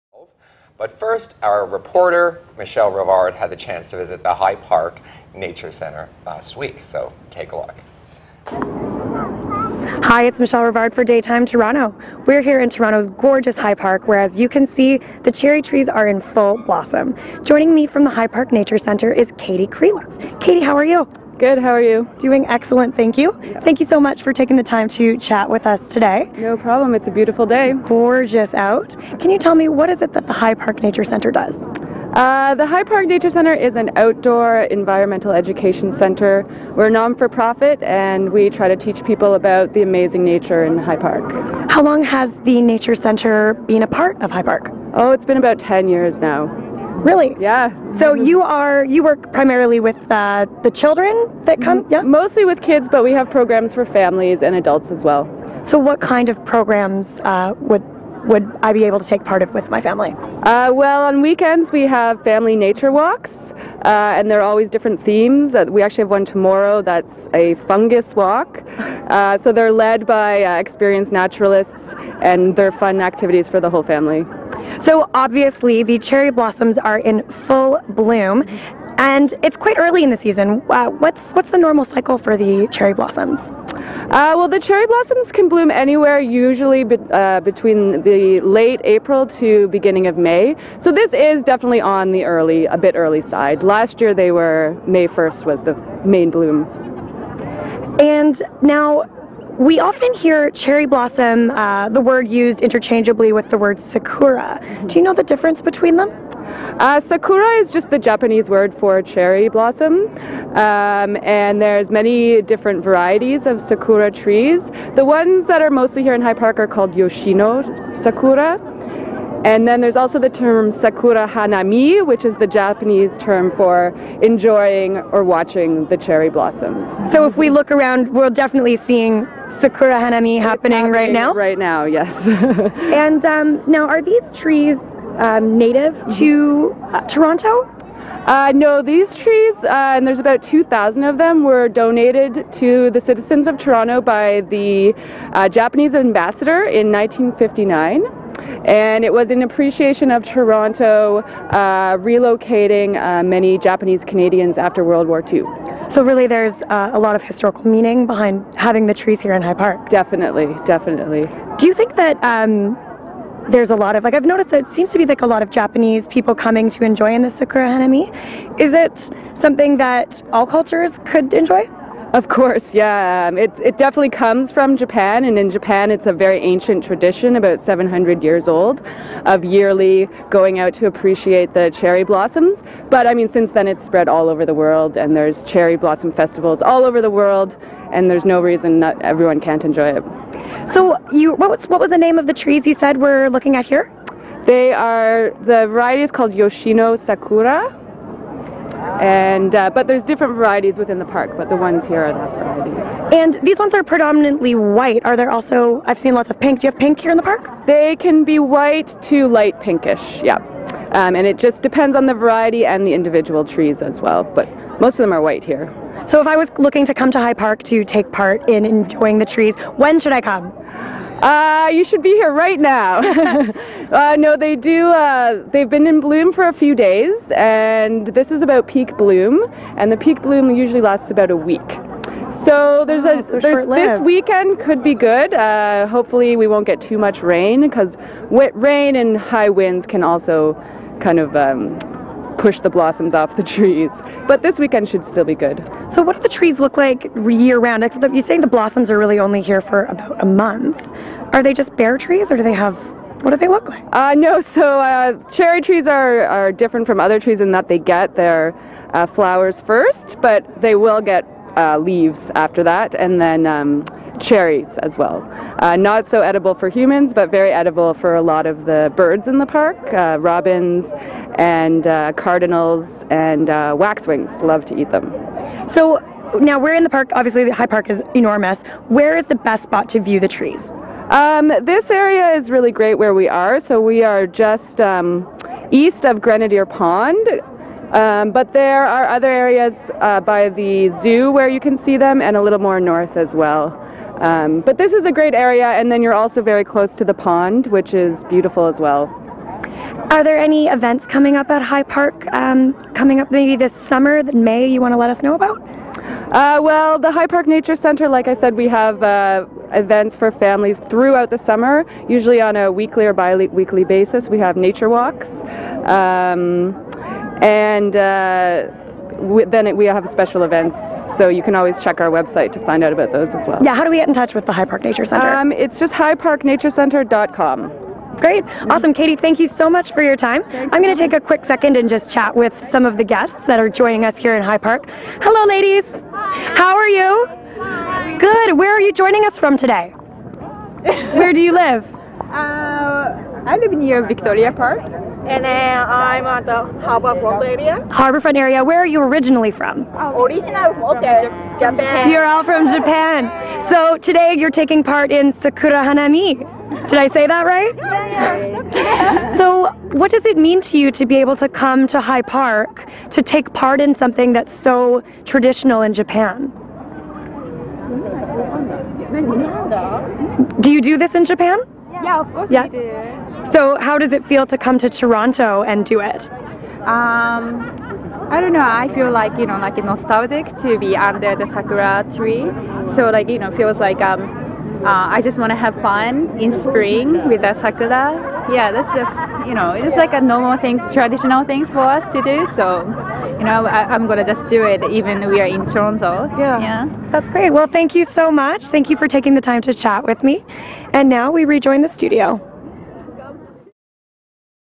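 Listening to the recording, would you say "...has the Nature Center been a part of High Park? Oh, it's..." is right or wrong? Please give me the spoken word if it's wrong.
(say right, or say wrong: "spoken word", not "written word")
right.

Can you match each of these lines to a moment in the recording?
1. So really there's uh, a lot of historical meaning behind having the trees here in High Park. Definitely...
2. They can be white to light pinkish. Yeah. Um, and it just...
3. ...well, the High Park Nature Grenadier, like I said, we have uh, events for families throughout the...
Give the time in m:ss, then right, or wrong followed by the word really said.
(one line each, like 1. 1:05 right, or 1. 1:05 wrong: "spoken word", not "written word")
1. 2:35 right
2. 3:27 right
3. 5:06 wrong: "Center", not "Grenadier".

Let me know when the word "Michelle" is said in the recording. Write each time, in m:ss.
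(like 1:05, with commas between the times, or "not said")
0:02, 0:10.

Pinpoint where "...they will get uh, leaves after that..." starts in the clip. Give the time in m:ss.
4:20.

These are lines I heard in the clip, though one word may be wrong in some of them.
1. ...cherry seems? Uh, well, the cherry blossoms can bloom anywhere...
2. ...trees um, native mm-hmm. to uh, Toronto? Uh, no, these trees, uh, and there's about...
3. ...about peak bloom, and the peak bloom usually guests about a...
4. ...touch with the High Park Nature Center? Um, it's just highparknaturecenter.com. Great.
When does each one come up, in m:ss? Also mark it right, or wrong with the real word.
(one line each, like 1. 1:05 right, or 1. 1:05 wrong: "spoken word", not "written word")
1. 1:22 wrong: "blossoms", not "seems"
2. 2:14 right
3. 3:48 wrong: "lasts", not "guests"
4. 5:24 right.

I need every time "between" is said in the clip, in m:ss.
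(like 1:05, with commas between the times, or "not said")
1:27, 1:45.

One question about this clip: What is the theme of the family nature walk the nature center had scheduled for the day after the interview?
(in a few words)
Fungus.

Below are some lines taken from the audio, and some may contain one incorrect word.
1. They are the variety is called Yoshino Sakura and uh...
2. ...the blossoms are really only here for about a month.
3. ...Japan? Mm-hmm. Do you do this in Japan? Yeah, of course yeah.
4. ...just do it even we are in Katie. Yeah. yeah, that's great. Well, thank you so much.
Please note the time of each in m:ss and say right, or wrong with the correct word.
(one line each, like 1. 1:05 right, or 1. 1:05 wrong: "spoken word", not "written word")
1. 3:14 right
2. 4:08 right
3. 6:05 right
4. 6:34 wrong: "Toronto", not "Katie".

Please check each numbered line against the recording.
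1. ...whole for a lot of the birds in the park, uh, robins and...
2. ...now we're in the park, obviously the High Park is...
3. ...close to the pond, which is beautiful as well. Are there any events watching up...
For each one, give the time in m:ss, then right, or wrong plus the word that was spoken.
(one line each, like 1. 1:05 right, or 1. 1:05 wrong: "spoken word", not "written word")
1. 4:27 wrong: "edible", not "whole"
2. 4:36 right
3. 4:56 wrong: "coming", not "watching".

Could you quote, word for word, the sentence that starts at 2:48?
Is it something that all cultures could enjoy?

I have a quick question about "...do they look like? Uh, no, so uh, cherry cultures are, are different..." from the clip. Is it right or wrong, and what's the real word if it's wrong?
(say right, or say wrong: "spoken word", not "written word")
wrong: "trees", not "cultures".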